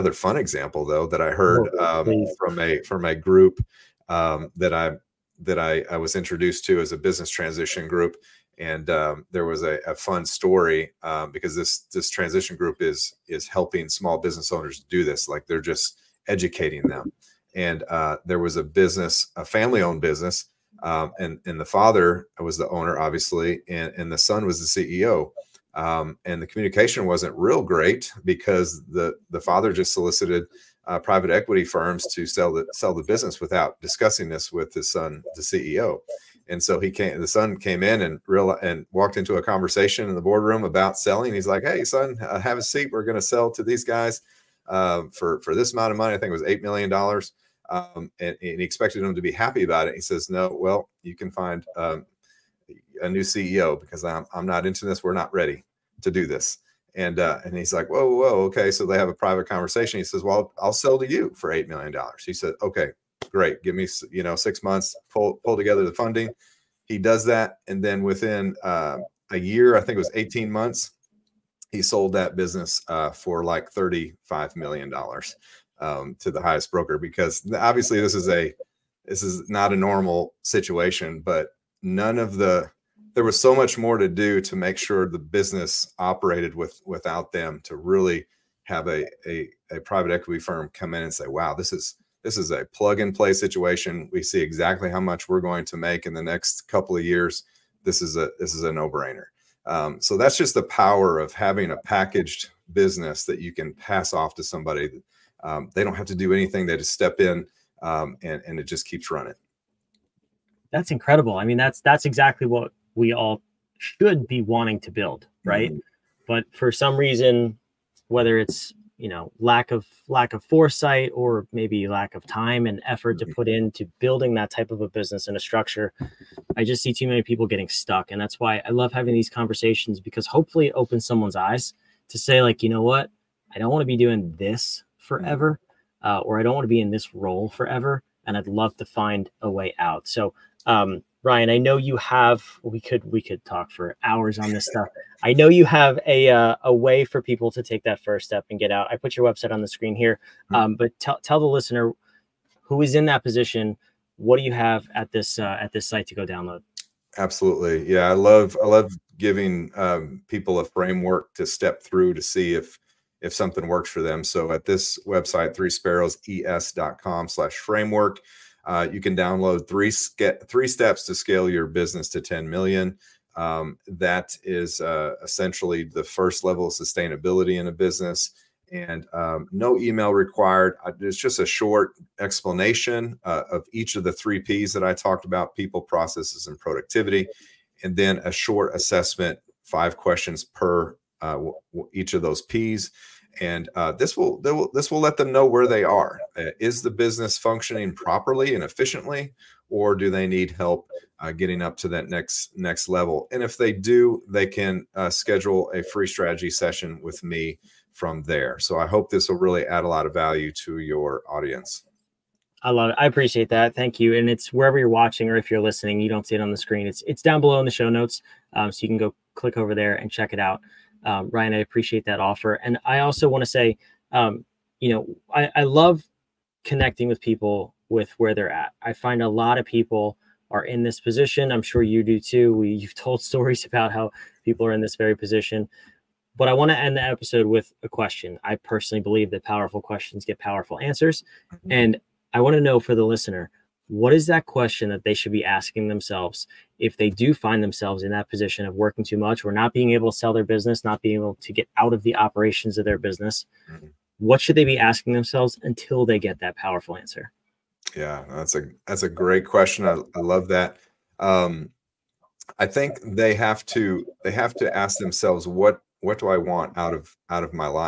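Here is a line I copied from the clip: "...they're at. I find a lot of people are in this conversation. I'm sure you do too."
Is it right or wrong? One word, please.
wrong.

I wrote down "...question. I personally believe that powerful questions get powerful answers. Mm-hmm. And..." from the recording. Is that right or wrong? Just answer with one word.
right.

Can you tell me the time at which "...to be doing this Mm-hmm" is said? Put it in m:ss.
2:13.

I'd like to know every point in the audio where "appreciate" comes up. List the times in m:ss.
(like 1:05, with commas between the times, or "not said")
3:33, 3:41.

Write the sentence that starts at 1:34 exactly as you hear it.
We see exactly how much we're going to make in the next couple of years.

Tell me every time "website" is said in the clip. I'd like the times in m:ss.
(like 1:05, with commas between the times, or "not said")
2:29, 2:45.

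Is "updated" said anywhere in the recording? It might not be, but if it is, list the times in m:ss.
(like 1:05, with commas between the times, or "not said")
not said.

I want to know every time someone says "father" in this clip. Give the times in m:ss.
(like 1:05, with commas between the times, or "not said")
0:21, 0:29.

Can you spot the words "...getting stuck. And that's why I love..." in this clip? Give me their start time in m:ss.
2:07.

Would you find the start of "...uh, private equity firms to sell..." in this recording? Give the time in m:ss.
0:30.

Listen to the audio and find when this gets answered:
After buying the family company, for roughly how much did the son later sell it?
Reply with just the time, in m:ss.
1:13.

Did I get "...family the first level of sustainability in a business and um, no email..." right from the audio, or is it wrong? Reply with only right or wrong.
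wrong.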